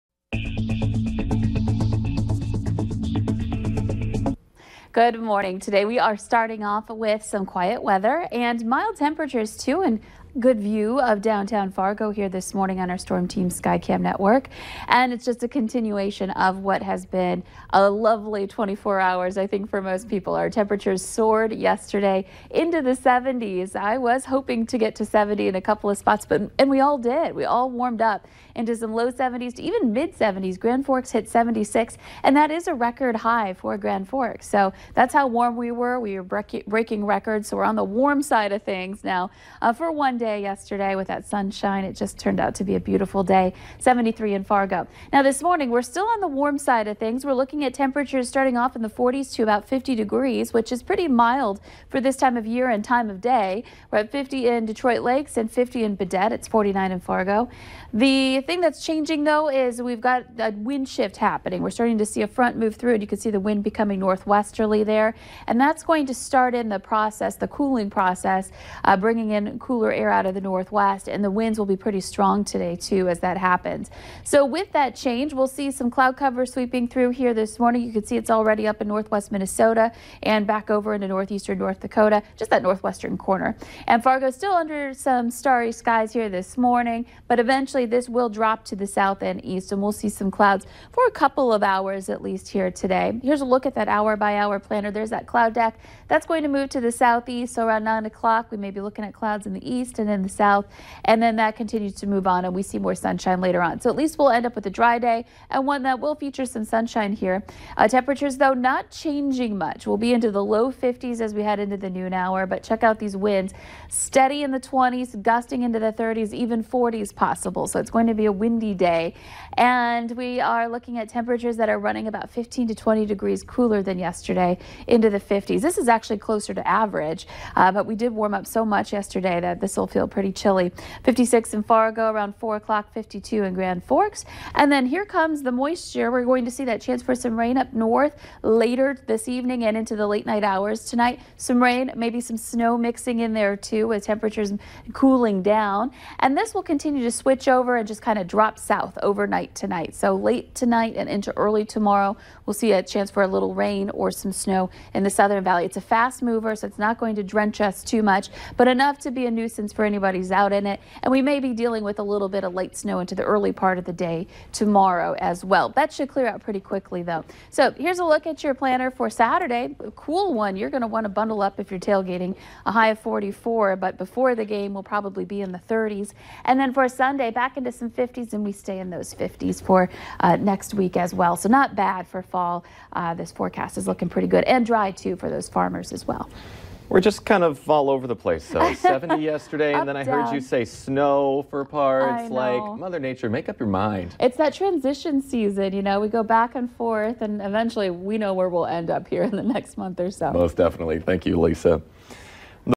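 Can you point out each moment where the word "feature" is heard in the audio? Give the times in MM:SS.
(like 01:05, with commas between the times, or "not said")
01:46.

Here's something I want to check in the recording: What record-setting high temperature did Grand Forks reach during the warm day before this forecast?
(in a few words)
76.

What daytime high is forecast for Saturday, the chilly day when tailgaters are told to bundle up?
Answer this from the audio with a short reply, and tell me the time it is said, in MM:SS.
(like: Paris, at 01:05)
44, at 02:52.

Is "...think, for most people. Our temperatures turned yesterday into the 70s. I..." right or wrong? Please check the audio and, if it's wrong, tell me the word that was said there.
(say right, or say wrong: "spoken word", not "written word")
wrong: "soared", not "turned".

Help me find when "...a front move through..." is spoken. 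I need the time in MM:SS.
01:02.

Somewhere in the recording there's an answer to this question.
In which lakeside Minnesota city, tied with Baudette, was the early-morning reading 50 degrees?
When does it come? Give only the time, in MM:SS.
00:54.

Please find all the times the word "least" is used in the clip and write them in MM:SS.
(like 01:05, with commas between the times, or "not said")
01:32, 01:43.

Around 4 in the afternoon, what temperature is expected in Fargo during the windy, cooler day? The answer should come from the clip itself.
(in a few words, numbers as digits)
56.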